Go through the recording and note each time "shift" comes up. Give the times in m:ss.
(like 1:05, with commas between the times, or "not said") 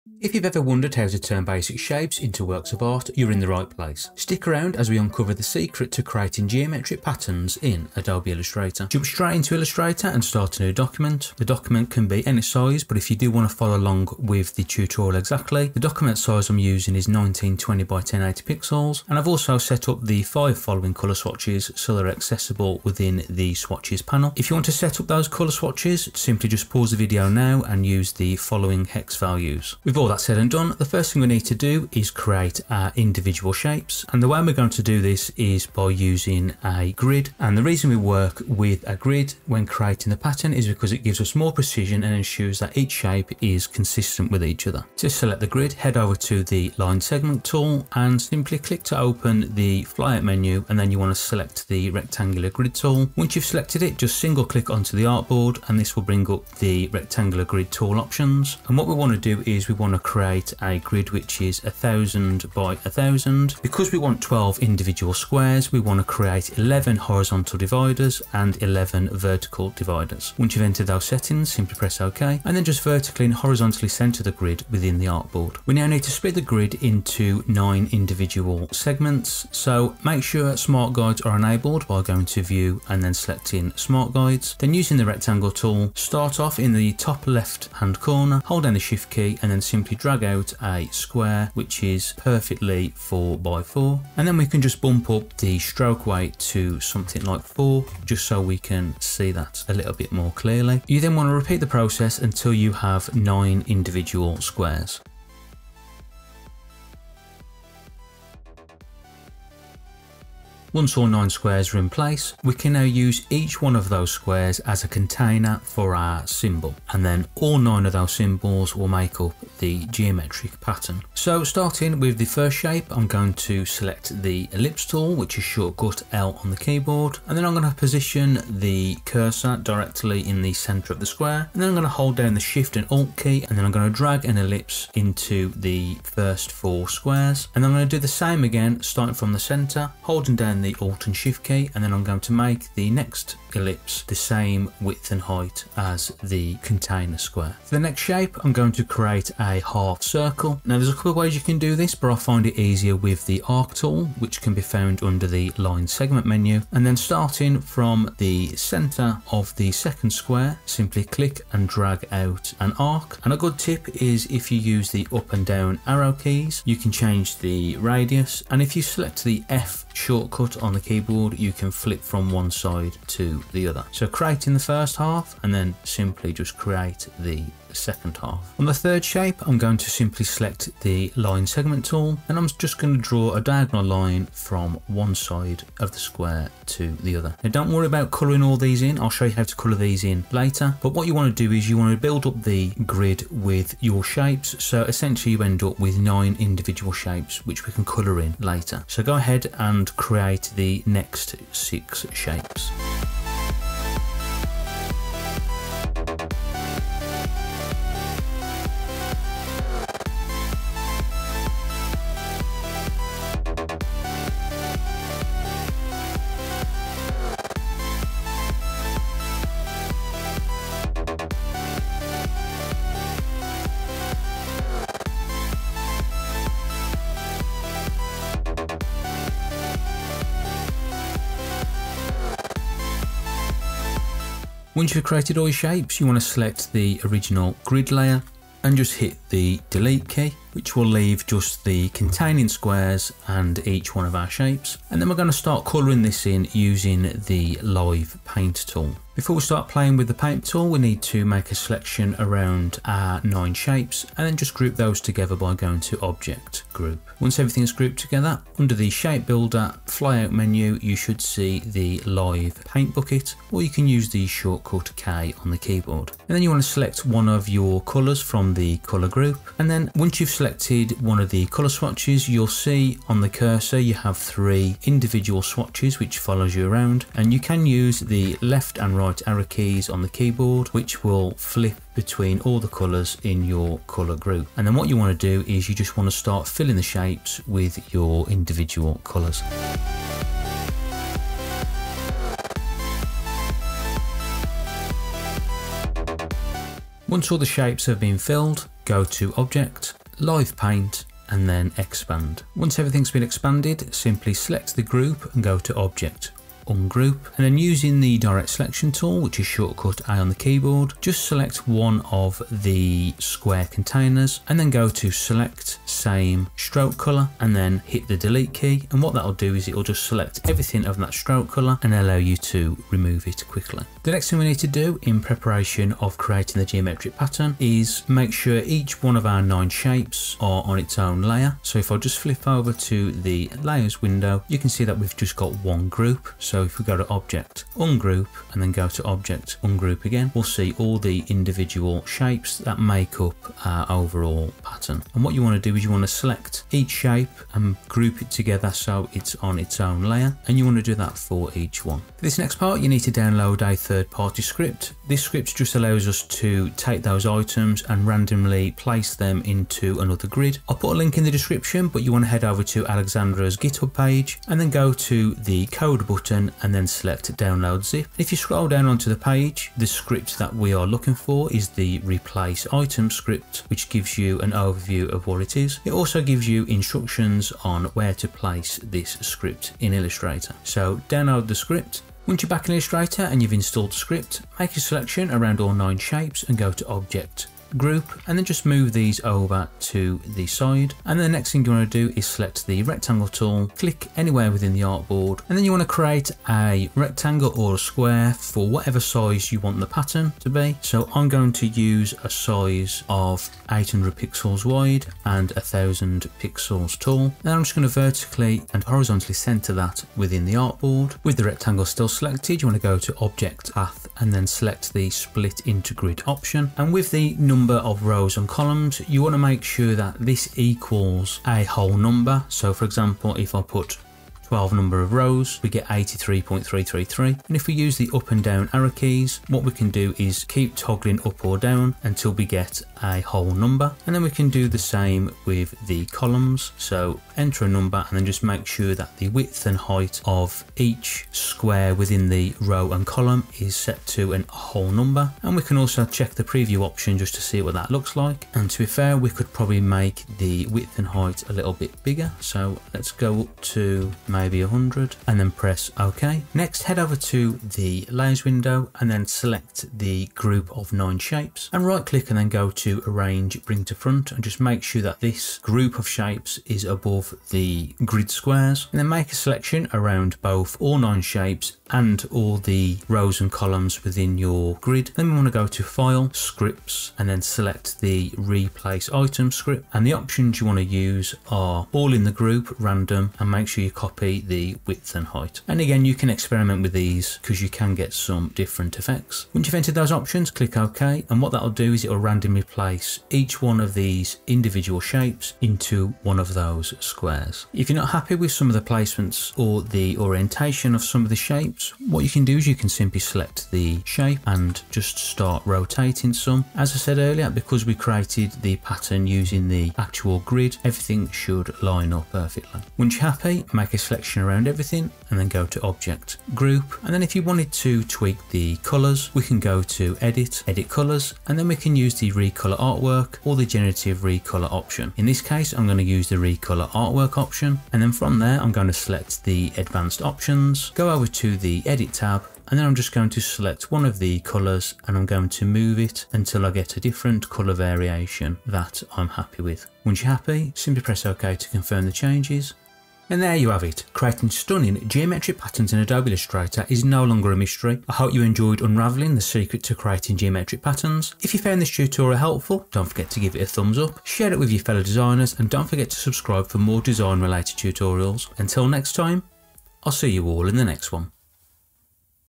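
1:28, 2:12, 2:21.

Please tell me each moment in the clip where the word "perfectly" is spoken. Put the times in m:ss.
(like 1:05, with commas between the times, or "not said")
1:32, 8:32.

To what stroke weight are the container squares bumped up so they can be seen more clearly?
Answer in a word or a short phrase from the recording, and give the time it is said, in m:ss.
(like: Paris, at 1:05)
4, at 1:36.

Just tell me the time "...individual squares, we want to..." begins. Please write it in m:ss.
1:04.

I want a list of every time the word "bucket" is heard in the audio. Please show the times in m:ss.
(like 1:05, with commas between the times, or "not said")
4:22.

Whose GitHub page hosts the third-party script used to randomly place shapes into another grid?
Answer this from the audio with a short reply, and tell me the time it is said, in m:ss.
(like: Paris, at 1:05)
Alexandra, at 6:02.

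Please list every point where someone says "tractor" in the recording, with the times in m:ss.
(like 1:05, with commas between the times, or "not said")
not said.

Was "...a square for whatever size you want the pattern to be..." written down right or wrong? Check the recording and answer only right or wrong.
right.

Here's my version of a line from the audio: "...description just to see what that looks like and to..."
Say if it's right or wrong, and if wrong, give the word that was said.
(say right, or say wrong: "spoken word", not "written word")
wrong: "option", not "description".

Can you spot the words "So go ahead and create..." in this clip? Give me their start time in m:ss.
3:18.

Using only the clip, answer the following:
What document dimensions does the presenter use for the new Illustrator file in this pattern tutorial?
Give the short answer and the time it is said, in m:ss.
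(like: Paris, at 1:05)
1920 by 1080 pixels, at 0:17.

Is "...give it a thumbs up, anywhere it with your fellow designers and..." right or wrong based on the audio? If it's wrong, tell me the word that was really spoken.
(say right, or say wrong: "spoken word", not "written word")
wrong: "share", not "anywhere".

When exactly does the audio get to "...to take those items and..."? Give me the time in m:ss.
5:56.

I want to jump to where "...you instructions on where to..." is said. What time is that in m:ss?
6:16.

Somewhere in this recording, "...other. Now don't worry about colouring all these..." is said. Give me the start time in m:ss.
3:07.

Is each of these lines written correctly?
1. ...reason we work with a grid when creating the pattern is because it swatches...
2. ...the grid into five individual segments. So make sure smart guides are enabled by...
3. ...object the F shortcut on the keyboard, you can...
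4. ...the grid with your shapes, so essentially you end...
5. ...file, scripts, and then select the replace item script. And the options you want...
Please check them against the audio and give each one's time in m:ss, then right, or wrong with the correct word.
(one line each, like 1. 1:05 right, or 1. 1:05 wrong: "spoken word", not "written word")
1. 0:37 wrong: "gives", not "swatches"
2. 1:16 wrong: "nine", not "five"
3. 2:48 wrong: "select", not "object"
4. 3:12 right
5. 7:55 right.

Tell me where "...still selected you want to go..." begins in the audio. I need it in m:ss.
6:51.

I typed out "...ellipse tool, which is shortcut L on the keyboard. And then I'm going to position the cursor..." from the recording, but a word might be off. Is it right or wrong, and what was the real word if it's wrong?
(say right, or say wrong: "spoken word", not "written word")
right.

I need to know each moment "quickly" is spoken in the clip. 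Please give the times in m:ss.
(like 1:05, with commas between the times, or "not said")
5:23.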